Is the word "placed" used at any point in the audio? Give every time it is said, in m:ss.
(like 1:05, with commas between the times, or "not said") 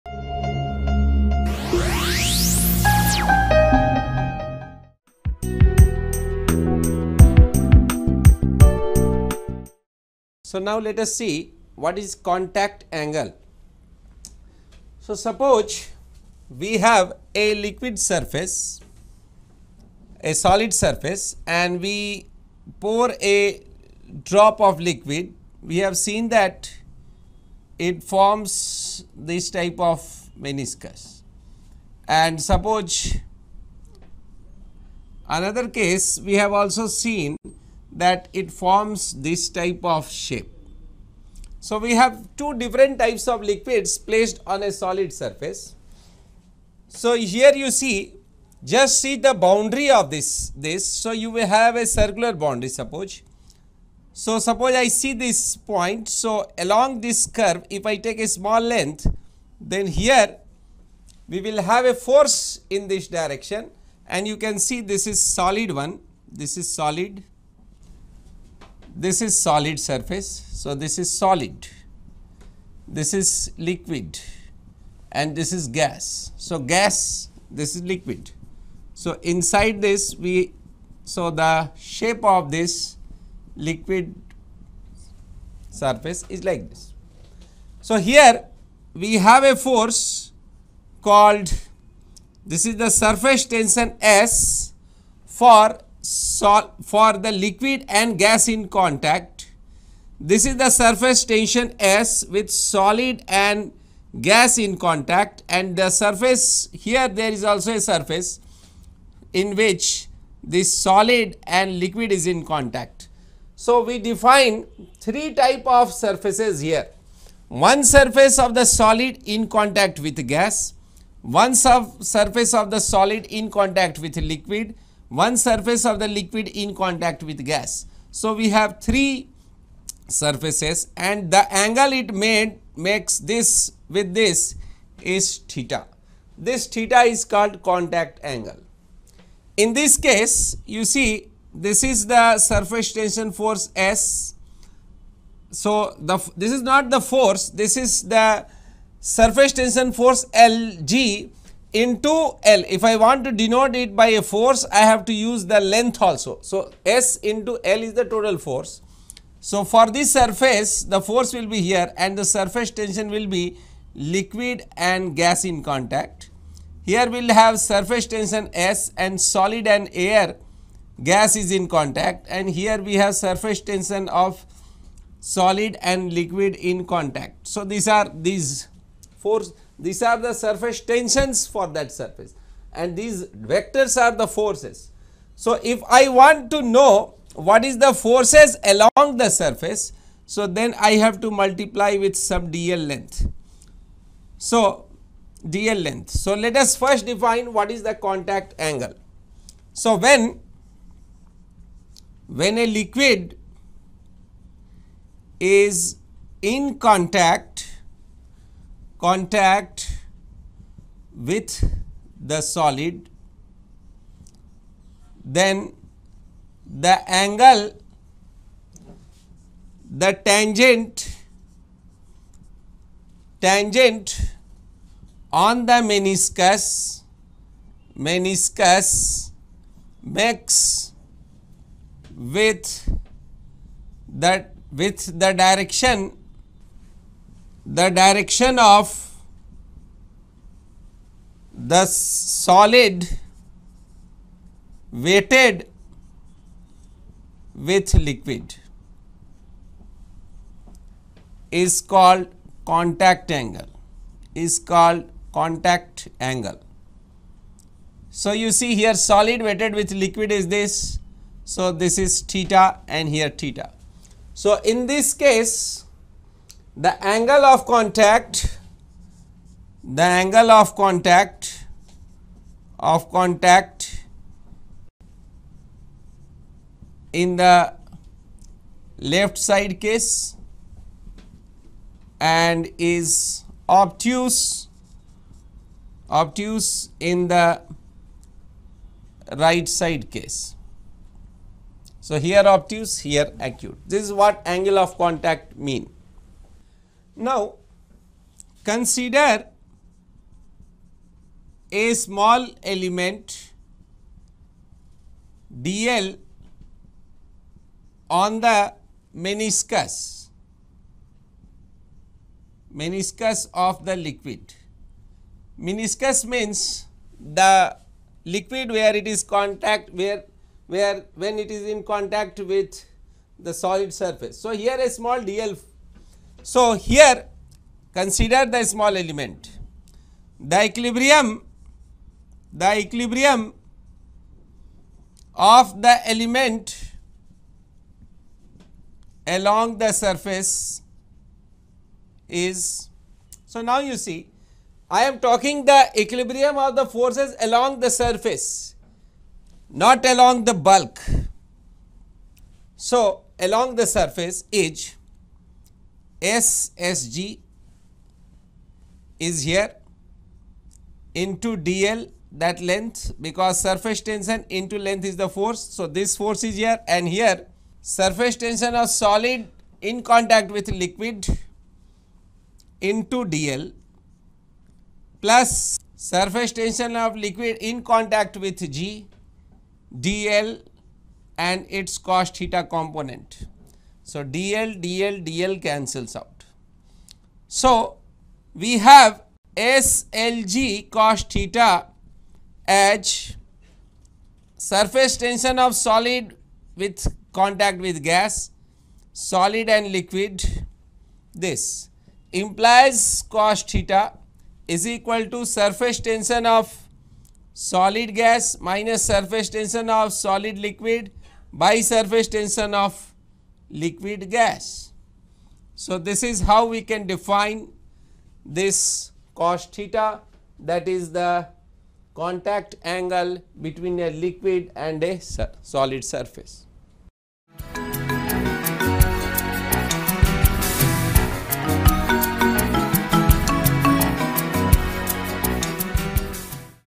0:44.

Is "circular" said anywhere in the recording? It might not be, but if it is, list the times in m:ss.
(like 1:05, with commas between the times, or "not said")
0:51.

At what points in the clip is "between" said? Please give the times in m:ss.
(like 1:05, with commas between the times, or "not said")
7:03.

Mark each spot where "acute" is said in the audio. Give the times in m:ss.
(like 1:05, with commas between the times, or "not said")
4:53.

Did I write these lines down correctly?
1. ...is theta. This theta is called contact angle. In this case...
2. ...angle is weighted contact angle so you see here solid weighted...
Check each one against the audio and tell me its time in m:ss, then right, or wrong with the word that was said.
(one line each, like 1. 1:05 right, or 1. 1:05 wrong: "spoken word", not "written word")
1. 2:15 right
2. 4:13 wrong: "called", not "weighted".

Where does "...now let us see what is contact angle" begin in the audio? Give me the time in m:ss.
0:10.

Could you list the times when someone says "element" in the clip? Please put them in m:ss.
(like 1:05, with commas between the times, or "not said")
5:02, 5:28, 5:36.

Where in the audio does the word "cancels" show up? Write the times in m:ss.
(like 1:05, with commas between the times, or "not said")
6:25.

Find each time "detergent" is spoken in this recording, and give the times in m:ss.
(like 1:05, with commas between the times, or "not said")
not said.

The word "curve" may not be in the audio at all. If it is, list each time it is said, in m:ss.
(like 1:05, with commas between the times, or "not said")
0:57.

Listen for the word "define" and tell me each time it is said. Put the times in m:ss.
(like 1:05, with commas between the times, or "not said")
1:53, 3:17, 6:57.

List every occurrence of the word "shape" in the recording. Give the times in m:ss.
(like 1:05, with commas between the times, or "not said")
0:40, 1:21.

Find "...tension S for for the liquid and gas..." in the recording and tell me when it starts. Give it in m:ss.
1:33.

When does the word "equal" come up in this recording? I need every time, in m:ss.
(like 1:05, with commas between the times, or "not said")
6:44.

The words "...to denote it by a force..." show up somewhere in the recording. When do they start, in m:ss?
2:33.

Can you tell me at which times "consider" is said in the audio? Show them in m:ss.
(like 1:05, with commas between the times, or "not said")
4:58, 5:27.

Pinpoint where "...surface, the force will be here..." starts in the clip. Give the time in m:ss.
2:40.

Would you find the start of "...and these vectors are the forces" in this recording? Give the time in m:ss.
3:02.